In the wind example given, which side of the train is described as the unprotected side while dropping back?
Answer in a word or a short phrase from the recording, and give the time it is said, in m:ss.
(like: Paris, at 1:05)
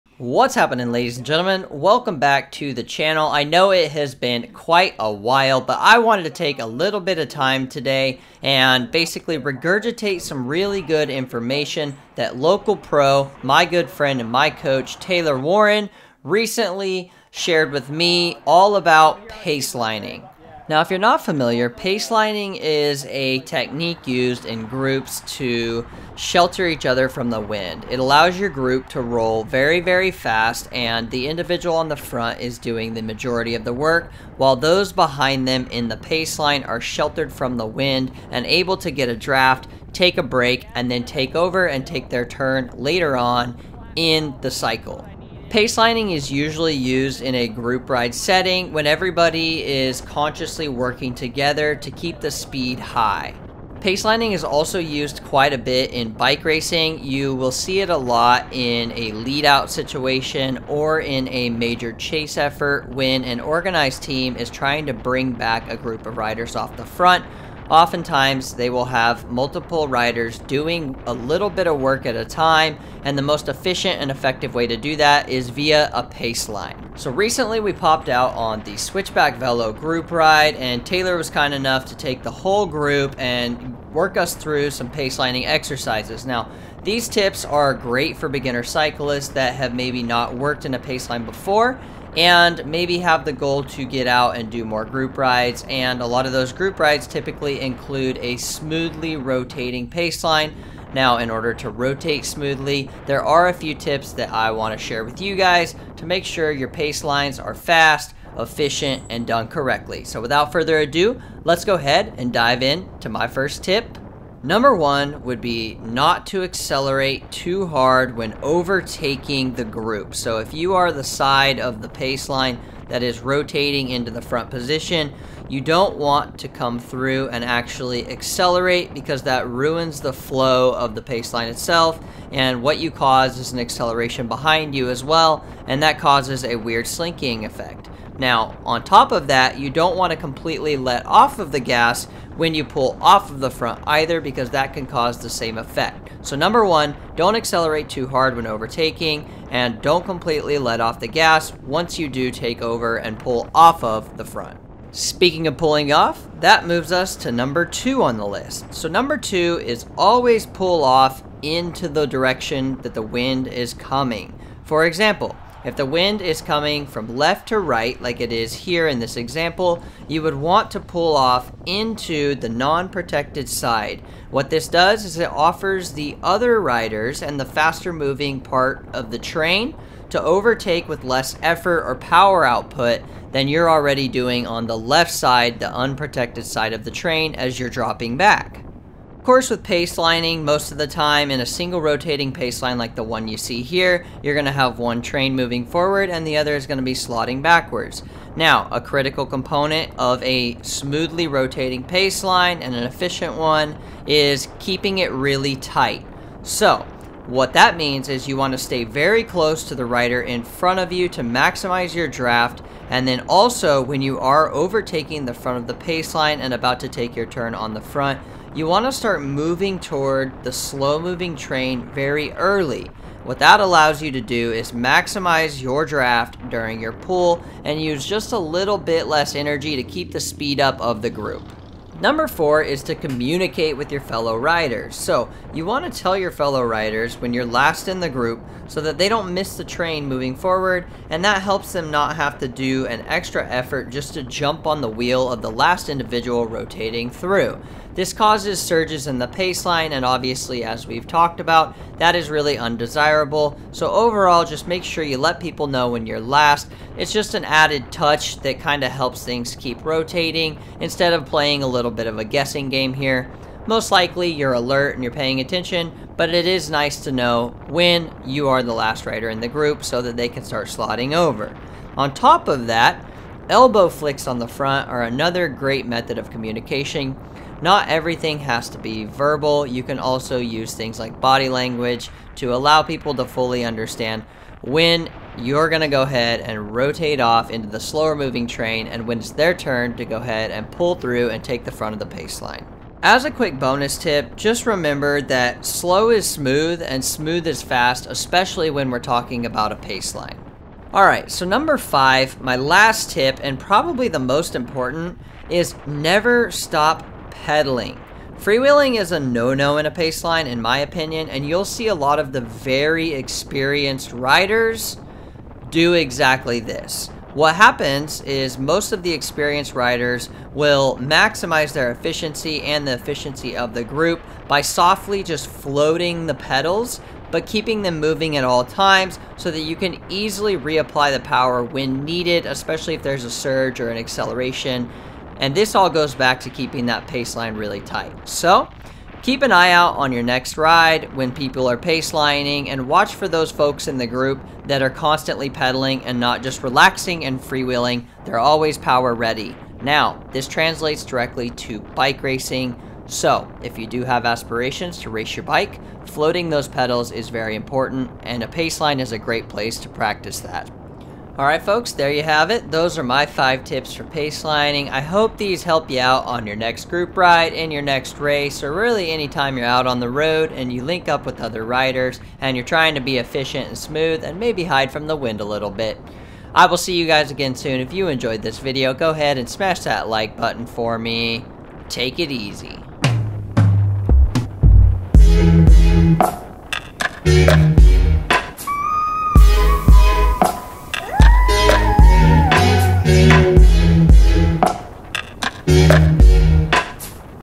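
left side, at 3:04.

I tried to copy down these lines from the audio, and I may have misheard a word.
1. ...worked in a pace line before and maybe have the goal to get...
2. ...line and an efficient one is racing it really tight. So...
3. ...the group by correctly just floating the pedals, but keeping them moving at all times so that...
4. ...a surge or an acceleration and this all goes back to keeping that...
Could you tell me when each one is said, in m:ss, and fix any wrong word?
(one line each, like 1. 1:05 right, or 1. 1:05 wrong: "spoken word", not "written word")
1. 1:30 right
2. 3:22 wrong: "keeping", not "racing"
3. 5:23 wrong: "softly", not "correctly"
4. 5:33 right.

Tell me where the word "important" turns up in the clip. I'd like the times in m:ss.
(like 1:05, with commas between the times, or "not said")
5:04, 5:57.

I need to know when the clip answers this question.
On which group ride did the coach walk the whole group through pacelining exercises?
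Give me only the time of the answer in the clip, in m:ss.
1:18.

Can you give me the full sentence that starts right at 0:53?
Pacelining is also used quite a bit in bike racing.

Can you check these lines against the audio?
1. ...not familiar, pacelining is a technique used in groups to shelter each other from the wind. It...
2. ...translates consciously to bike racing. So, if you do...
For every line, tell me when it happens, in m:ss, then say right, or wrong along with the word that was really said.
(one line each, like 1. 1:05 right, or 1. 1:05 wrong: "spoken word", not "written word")
1. 0:20 right
2. 5:50 wrong: "directly", not "consciously".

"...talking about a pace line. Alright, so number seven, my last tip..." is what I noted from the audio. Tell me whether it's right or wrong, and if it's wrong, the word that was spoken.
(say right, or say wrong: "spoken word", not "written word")
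wrong: "five", not "seven".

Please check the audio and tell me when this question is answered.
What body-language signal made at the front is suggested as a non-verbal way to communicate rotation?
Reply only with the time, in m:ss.
4:33.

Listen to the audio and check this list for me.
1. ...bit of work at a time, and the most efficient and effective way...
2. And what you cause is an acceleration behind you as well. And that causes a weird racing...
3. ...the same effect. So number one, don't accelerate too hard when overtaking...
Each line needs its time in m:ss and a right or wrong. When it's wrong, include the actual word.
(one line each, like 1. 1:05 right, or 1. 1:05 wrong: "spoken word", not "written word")
1. 1:11 right
2. 2:12 wrong: "slinking", not "racing"
3. 2:25 right.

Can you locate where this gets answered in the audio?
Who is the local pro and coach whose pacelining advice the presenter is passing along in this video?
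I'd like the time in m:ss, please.
0:14.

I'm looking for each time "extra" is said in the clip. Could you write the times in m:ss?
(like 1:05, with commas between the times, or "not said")
4:03.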